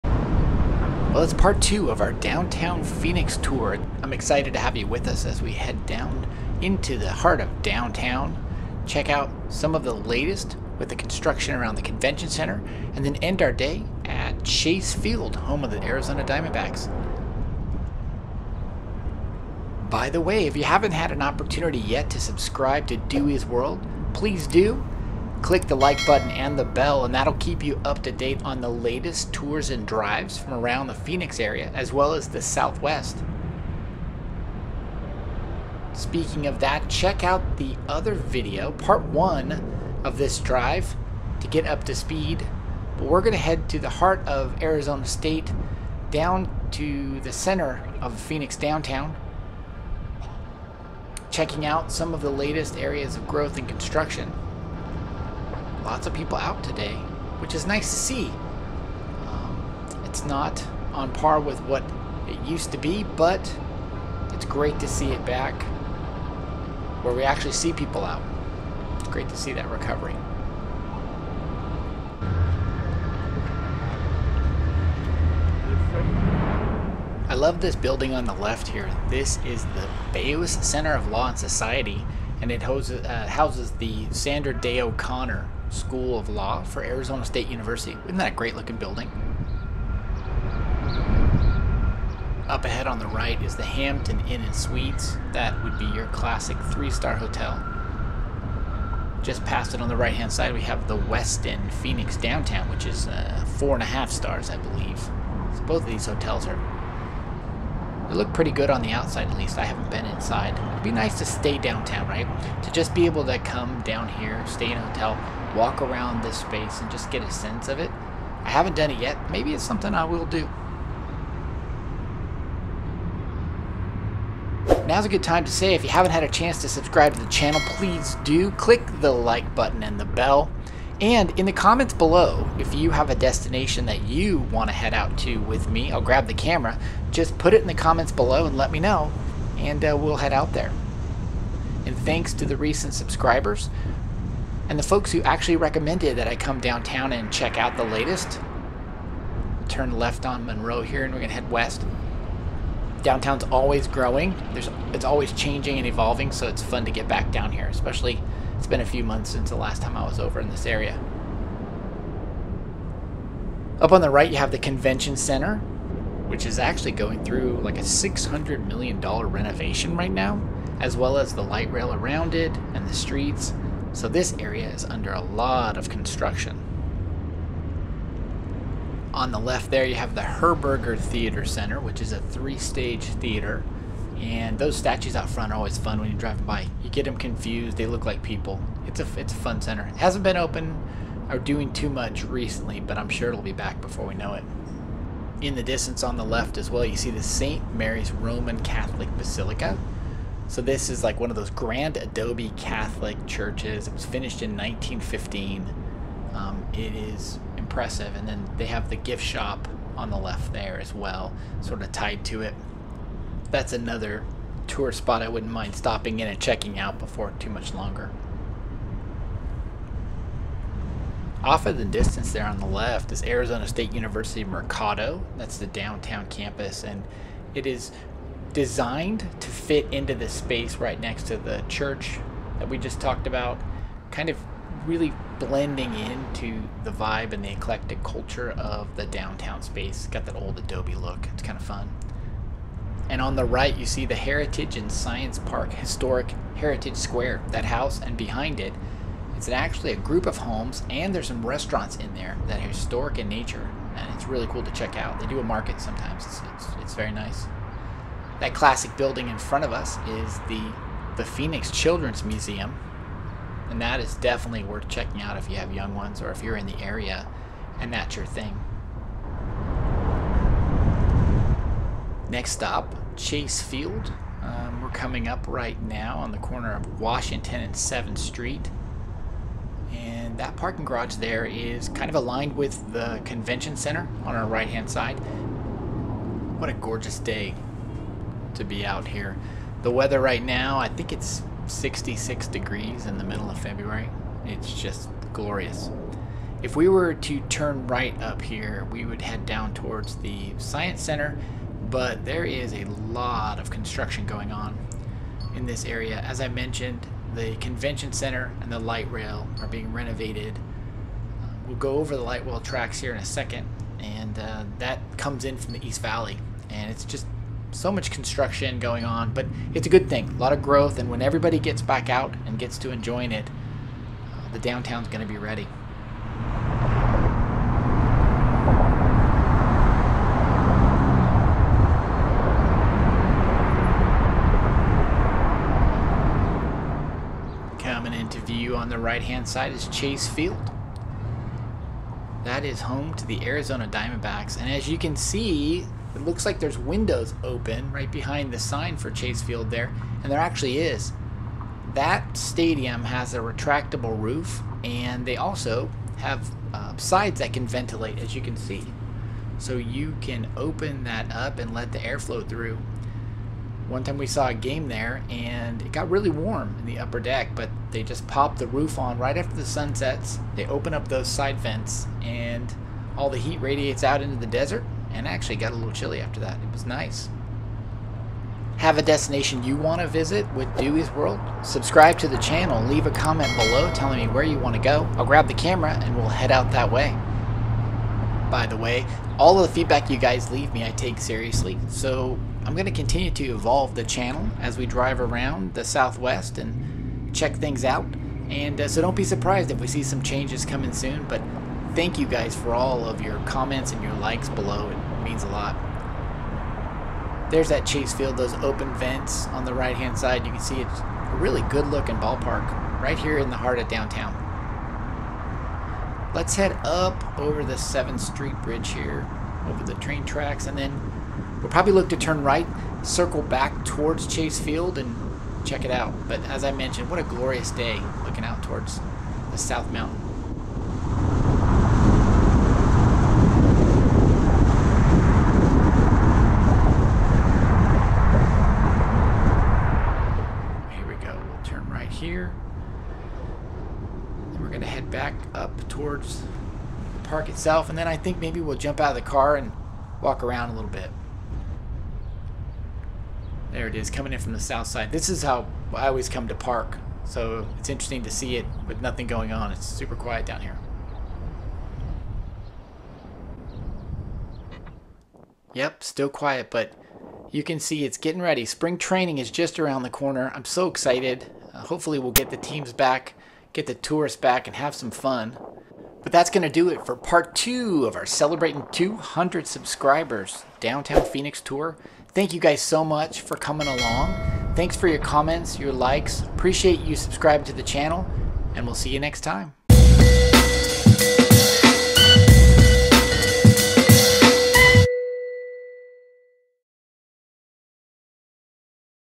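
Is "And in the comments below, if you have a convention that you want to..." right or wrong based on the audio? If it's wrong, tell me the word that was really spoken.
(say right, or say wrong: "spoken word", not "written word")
wrong: "destination", not "convention".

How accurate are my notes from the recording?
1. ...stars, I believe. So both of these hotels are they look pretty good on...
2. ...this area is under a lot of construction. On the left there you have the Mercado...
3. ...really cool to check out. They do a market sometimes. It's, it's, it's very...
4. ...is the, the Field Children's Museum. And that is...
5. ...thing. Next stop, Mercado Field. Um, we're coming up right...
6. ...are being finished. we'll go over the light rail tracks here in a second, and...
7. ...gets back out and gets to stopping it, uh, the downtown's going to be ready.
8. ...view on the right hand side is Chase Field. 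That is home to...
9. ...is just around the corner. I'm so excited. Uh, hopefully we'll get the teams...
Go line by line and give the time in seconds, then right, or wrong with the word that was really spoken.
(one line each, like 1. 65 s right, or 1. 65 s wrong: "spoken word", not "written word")
1. 104 s right
2. 174 s wrong: "Herberger", not "Mercado"
3. 254 s right
4. 260 s wrong: "Phoenix", not "Field"
5. 268 s wrong: "Chase", not "Mercado"
6. 309 s wrong: "renovated", not "finished"
7. 321 s wrong: "enjoying", not "stopping"
8. 338 s right
9. 469 s right.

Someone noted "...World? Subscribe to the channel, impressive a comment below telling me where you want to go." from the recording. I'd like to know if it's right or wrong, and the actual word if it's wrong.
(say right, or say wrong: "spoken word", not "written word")
wrong: "leave", not "impressive".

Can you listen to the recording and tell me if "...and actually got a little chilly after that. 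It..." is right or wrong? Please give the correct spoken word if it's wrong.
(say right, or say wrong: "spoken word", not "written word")
right.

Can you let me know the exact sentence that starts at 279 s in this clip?
And that parking garage there is kind of aligned with the convention center on our right hand side.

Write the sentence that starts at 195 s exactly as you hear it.
In the distance on the left as well, you see the St.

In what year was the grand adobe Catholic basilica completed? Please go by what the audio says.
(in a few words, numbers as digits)
1915.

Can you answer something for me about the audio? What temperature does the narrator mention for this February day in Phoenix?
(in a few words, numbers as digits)
66 degrees.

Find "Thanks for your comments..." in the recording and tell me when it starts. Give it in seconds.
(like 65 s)
484 s.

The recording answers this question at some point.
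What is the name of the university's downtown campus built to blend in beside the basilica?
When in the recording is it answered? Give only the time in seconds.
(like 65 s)
223 s.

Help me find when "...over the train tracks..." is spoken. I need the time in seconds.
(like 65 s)
419 s.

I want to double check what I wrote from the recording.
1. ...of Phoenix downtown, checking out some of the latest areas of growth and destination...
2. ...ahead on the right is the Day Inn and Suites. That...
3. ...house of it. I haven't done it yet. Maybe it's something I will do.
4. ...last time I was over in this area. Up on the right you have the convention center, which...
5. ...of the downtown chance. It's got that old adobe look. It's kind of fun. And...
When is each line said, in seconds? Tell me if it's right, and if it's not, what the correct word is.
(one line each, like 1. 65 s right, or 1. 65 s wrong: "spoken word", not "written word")
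1. 47 s wrong: "construction", not "destination"
2. 92 s wrong: "Hampton", not "Day"
3. 117 s wrong: "sense", not "house"
4. 159 s right
5. 238 s wrong: "space", not "chance".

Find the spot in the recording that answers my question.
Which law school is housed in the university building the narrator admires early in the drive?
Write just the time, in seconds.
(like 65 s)
84 s.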